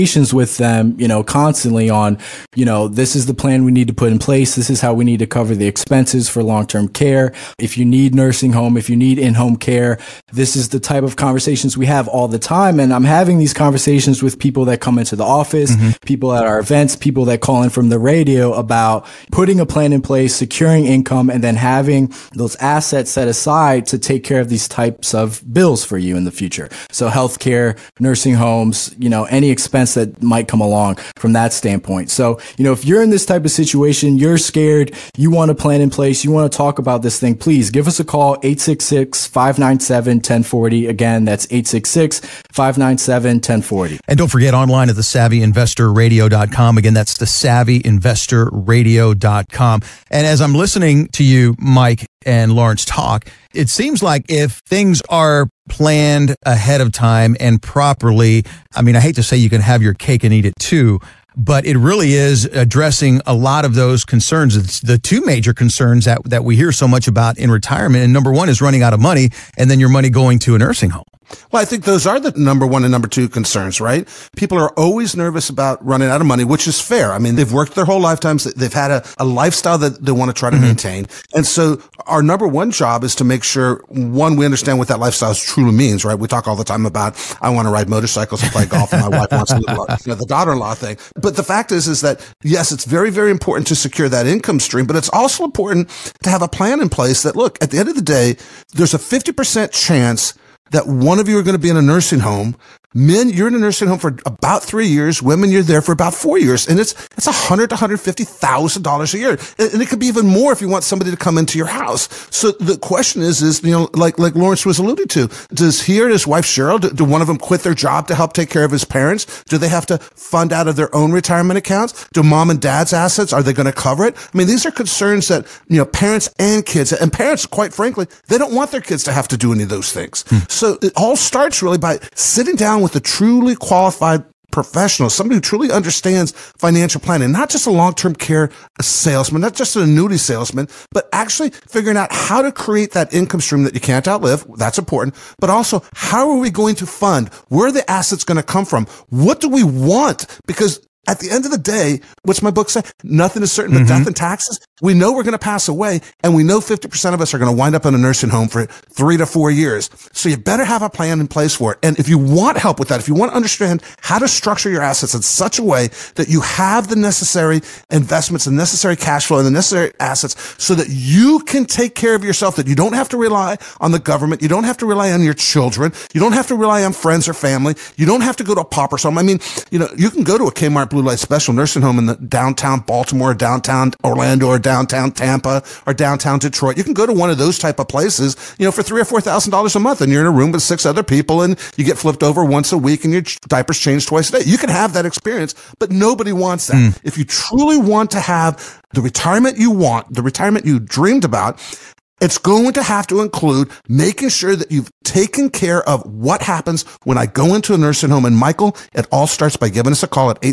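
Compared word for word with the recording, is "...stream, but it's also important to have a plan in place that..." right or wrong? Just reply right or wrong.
right.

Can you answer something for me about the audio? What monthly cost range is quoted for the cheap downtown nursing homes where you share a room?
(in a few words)
$3,000 to $4,000.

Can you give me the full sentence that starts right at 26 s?
So healthcare, nursing homes, you know, any expense that might come along from that standpoint.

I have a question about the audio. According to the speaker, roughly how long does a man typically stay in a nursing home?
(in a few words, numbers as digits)
3 years.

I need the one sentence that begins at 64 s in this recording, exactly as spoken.
It's the two major concerns that, that we hear so much about in retirement.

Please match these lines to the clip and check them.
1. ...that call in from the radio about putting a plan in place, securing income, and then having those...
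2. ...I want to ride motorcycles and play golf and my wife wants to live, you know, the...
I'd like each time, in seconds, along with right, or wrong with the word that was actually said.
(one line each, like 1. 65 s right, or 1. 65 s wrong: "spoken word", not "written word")
1. 17 s right
2. 87 s right.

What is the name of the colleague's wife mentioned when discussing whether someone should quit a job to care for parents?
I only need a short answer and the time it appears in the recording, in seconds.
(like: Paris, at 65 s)
Cheryl, at 116 s.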